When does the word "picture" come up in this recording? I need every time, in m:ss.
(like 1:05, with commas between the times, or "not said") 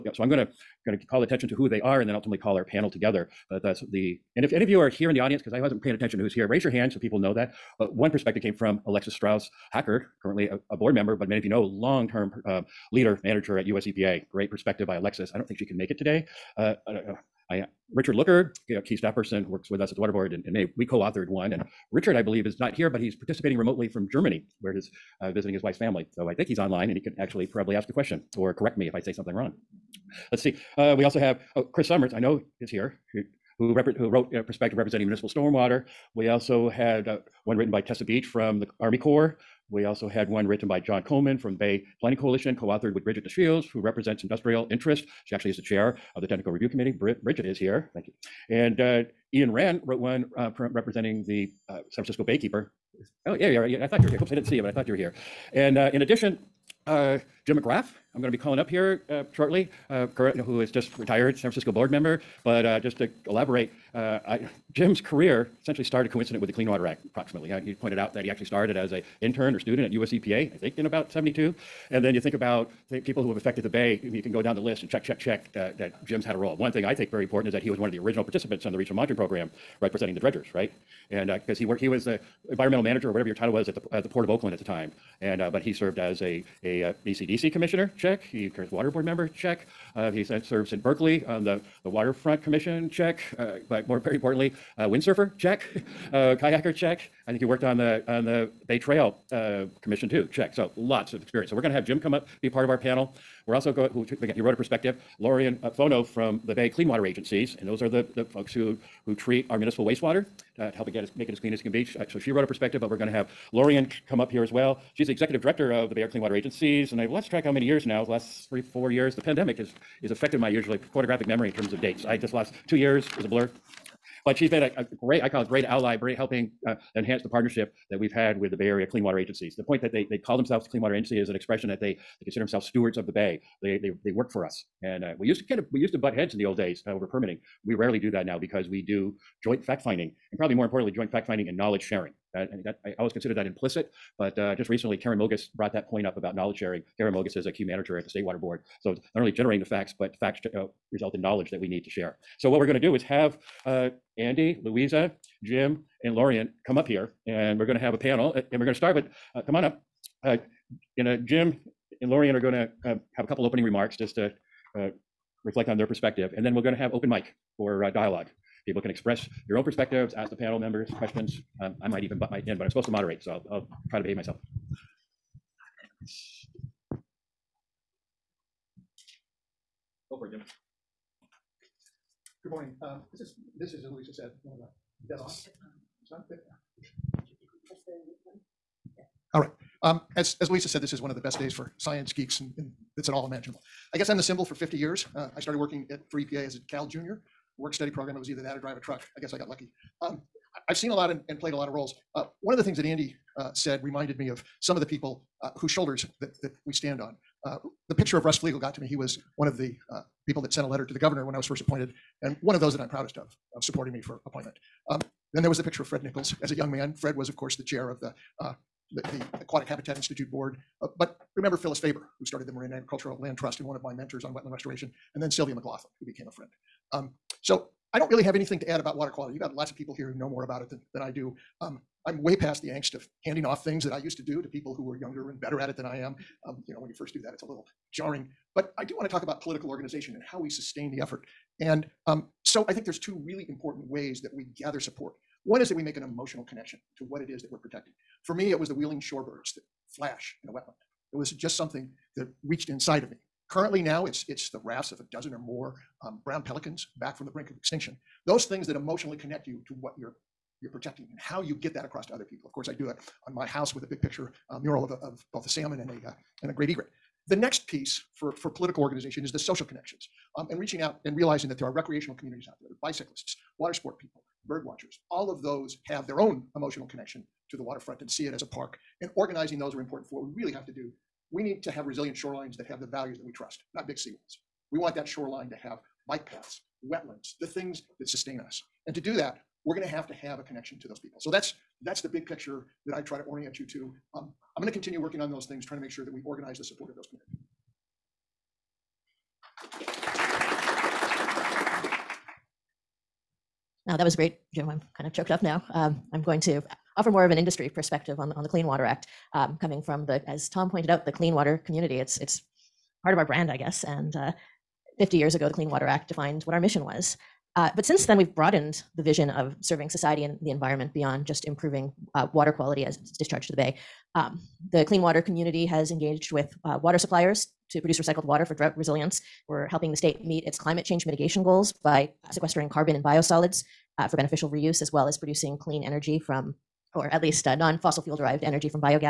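3:27, 3:35, 4:24, 4:52.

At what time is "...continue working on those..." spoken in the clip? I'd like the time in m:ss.
4:54.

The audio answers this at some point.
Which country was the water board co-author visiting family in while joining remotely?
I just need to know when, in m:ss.
0:24.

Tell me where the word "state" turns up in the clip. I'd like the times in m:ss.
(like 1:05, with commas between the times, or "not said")
2:28, 5:29.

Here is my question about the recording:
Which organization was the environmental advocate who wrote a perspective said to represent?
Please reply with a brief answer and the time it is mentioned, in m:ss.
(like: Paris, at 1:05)
San Francisco Baykeeper, at 0:51.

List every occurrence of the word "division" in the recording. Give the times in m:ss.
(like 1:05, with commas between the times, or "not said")
not said.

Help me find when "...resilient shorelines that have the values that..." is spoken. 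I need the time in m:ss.
4:41.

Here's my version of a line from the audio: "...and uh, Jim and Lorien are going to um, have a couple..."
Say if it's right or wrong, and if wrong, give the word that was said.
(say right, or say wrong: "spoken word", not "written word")
right.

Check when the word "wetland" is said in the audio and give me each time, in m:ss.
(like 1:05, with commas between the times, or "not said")
3:44, 4:10, 4:46.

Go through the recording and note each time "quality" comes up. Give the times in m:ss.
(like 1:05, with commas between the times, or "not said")
3:49, 5:22.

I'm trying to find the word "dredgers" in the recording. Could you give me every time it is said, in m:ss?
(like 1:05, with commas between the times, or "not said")
1:20.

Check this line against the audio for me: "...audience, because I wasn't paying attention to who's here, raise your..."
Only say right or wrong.
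right.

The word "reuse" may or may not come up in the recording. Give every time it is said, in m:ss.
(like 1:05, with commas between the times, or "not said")
5:34.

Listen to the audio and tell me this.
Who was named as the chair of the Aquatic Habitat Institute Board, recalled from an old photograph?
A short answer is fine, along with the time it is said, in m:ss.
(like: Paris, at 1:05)
Fred Nichols, at 3:35.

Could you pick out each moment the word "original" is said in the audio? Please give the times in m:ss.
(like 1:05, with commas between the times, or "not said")
1:17.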